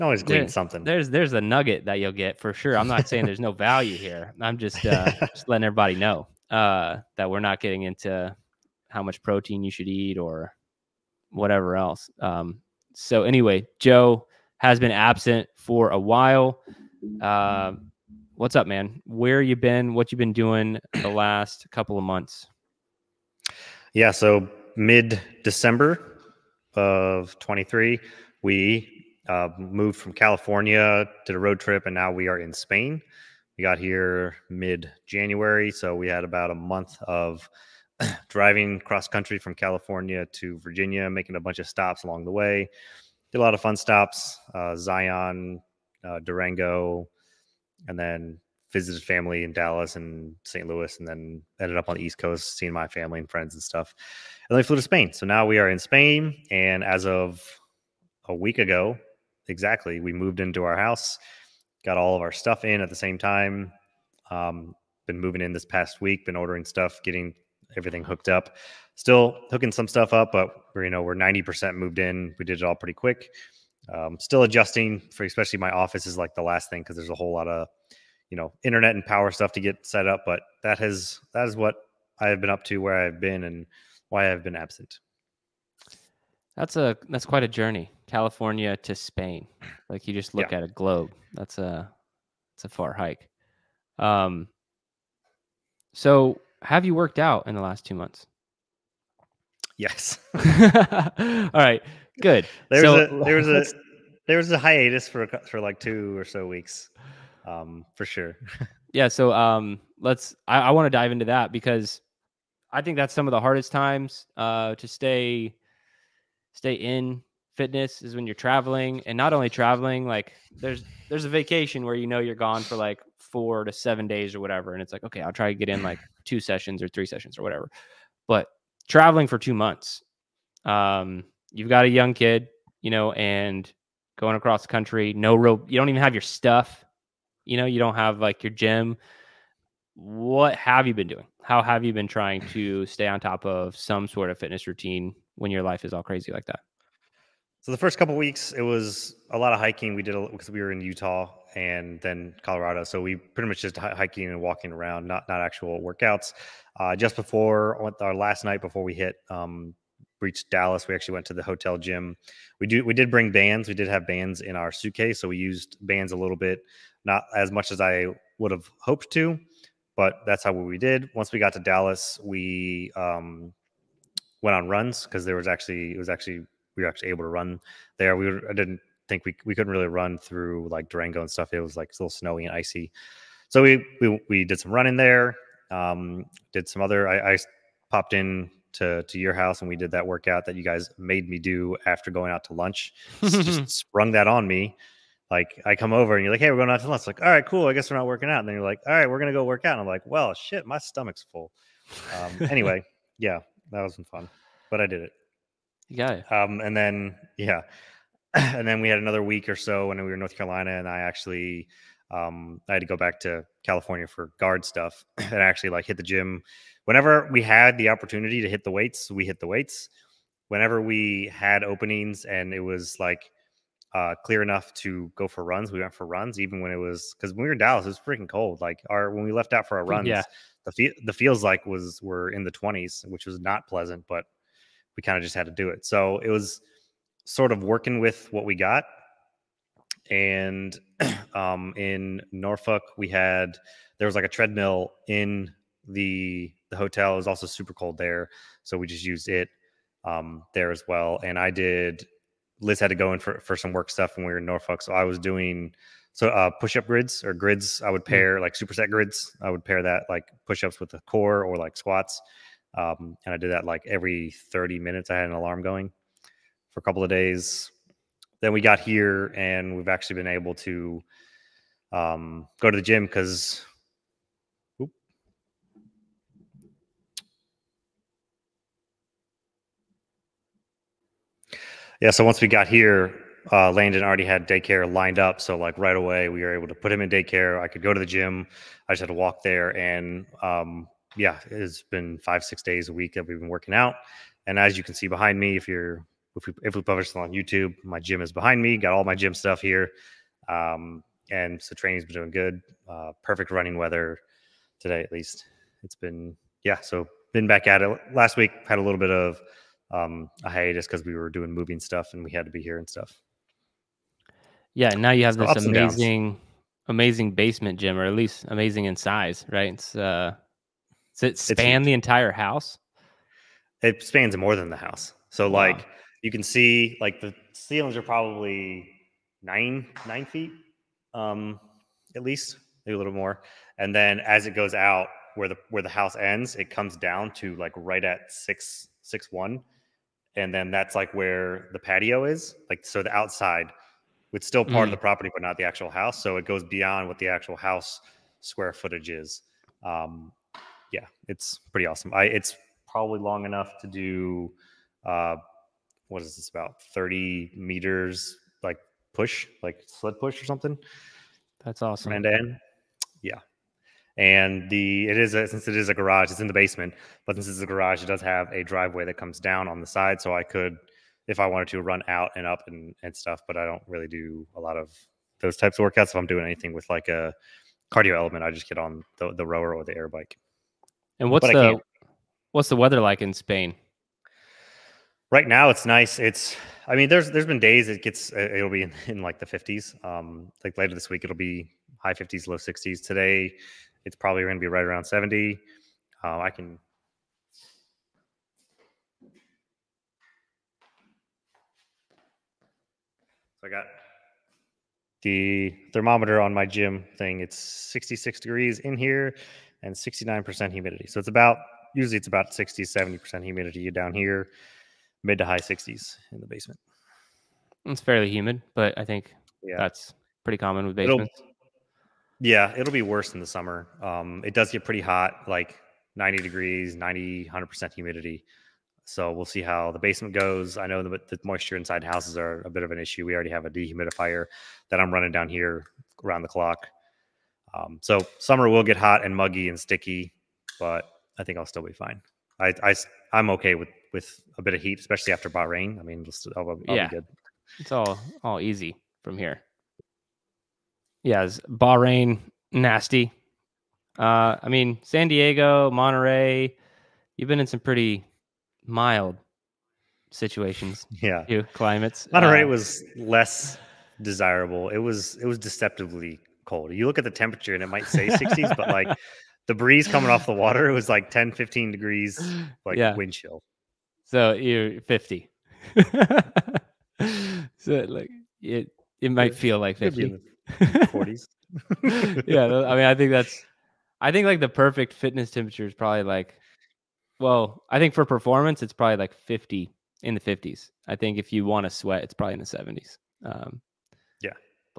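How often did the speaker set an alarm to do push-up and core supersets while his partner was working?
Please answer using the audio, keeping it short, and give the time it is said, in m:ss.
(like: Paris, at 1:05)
every 30 minutes, at 4:23.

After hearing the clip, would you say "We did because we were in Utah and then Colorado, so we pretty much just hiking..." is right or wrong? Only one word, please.
right.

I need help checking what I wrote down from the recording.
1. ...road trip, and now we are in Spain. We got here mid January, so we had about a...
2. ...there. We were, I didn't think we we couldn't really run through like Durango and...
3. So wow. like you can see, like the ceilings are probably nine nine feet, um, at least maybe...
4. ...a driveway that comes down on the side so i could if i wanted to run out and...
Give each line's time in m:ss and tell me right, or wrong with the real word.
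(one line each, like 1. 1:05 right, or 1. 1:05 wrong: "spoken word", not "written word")
1. 0:31 right
2. 2:57 right
3. 5:25 right
4. 6:08 right.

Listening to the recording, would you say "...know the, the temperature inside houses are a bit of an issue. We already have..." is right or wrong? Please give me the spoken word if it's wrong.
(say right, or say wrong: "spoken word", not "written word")
wrong: "moisture", not "temperature".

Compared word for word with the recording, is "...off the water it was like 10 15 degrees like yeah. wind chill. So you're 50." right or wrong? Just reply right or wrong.
right.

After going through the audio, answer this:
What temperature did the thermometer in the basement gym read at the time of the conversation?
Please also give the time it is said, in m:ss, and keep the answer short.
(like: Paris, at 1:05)
66 degrees, at 6:47.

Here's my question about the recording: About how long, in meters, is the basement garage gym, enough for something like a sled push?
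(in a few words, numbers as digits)
30 meters.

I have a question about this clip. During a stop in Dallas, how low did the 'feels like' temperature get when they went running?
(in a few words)
the twenties.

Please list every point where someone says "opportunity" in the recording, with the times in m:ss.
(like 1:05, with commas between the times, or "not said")
3:37.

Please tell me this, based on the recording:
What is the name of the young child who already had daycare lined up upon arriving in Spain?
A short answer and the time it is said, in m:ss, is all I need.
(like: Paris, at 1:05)
Landon, at 4:43.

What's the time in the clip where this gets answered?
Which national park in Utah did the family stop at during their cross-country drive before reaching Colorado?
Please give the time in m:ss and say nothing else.
0:44.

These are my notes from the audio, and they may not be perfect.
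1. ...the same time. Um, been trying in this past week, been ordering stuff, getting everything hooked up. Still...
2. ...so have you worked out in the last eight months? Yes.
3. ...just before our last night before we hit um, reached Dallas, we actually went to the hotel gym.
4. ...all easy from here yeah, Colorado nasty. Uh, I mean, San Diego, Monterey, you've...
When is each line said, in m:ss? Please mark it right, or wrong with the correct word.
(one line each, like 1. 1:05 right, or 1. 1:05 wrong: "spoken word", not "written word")
1. 1:02 wrong: "moving", not "trying"
2. 1:35 wrong: "two", not "eight"
3. 2:36 right
4. 7:28 wrong: "Bahrain", not "Colorado".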